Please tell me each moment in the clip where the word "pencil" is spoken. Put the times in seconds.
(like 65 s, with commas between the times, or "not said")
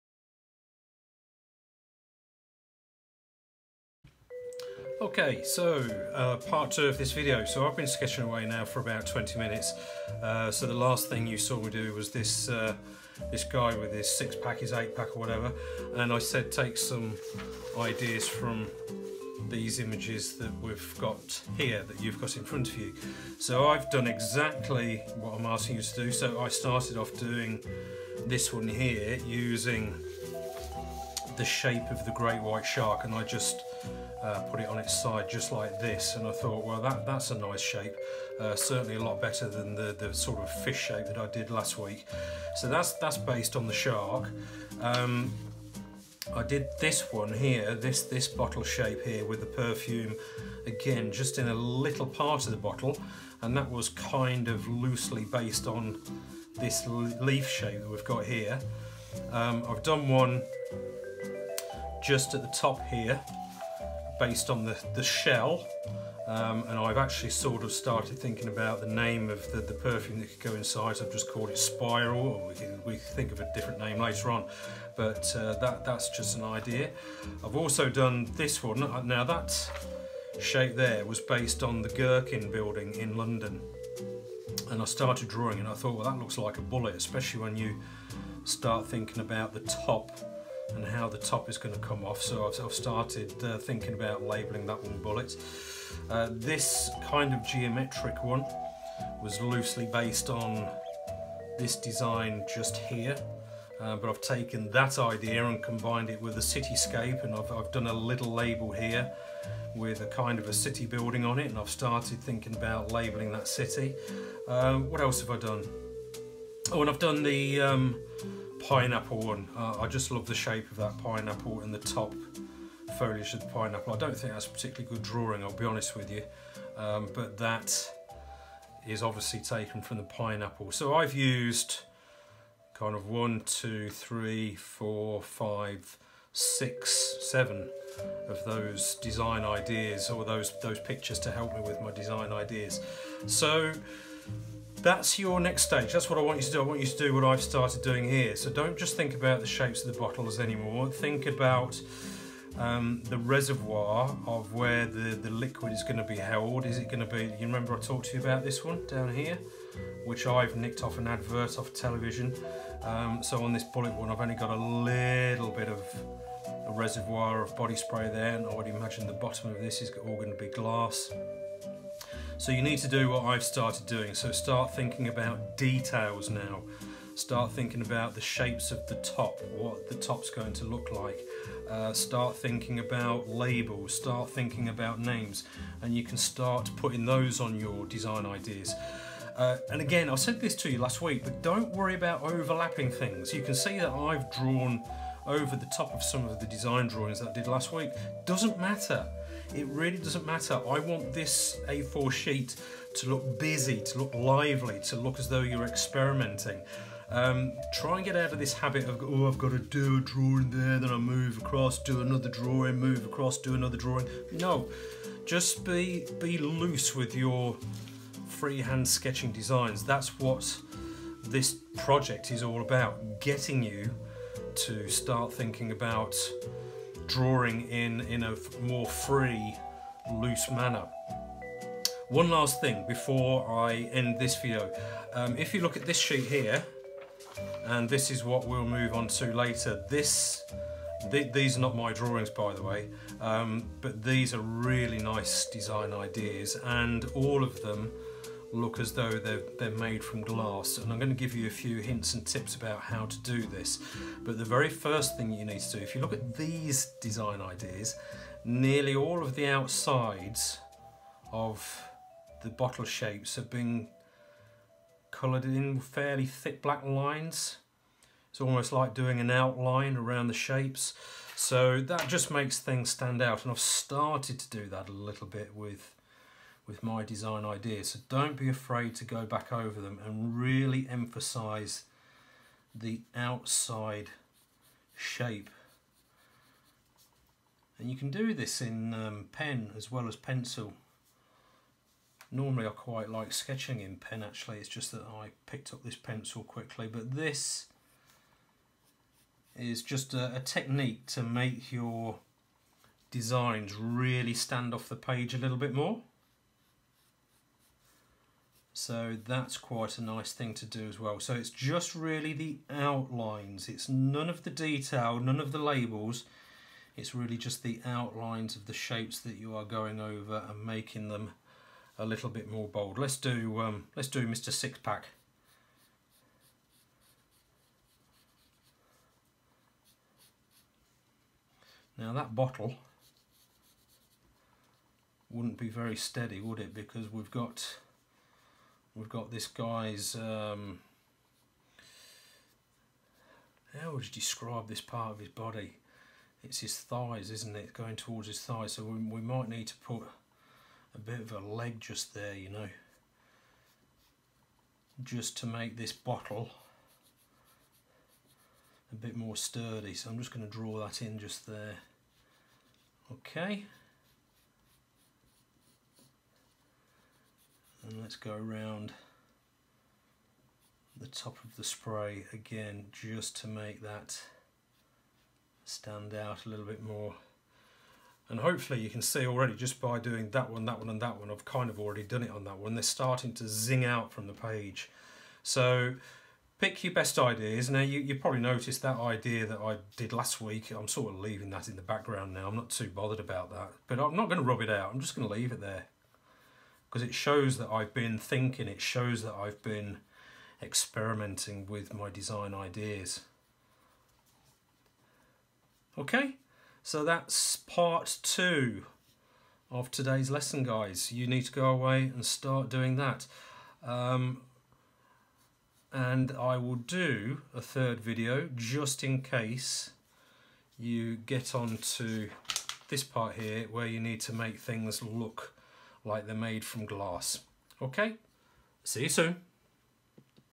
290 s, 295 s.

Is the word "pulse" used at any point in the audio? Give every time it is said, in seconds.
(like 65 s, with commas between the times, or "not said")
not said.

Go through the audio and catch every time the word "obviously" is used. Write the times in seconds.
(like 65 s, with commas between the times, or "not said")
129 s.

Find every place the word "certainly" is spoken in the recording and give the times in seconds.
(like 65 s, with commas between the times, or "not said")
38 s.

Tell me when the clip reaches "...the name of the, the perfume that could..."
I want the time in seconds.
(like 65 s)
68 s.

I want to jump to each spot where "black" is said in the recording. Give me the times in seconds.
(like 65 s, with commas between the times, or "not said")
266 s.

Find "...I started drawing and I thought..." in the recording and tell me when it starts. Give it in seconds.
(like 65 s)
84 s.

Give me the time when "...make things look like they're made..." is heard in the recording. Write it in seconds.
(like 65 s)
424 s.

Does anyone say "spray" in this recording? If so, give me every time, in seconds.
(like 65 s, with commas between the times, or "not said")
167 s, 371 s.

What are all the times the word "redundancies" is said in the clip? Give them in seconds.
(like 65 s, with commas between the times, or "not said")
not said.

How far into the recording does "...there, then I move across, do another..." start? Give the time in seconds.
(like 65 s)
210 s.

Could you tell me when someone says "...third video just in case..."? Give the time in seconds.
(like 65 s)
417 s.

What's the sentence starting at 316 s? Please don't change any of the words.
It's really just the outlines of the shapes that you are going over and making them a little bit more bold.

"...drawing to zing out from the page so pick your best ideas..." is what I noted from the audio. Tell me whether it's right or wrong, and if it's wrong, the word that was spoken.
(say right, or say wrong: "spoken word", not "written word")
wrong: "starting", not "drawing".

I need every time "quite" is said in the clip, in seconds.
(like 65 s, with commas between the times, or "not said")
292 s, 309 s.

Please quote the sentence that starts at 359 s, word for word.
So I'm just going to draw that in just there.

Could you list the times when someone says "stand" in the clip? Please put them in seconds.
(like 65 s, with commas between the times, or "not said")
272 s, 304 s, 375 s.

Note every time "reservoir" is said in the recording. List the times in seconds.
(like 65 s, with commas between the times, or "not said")
153 s, 166 s.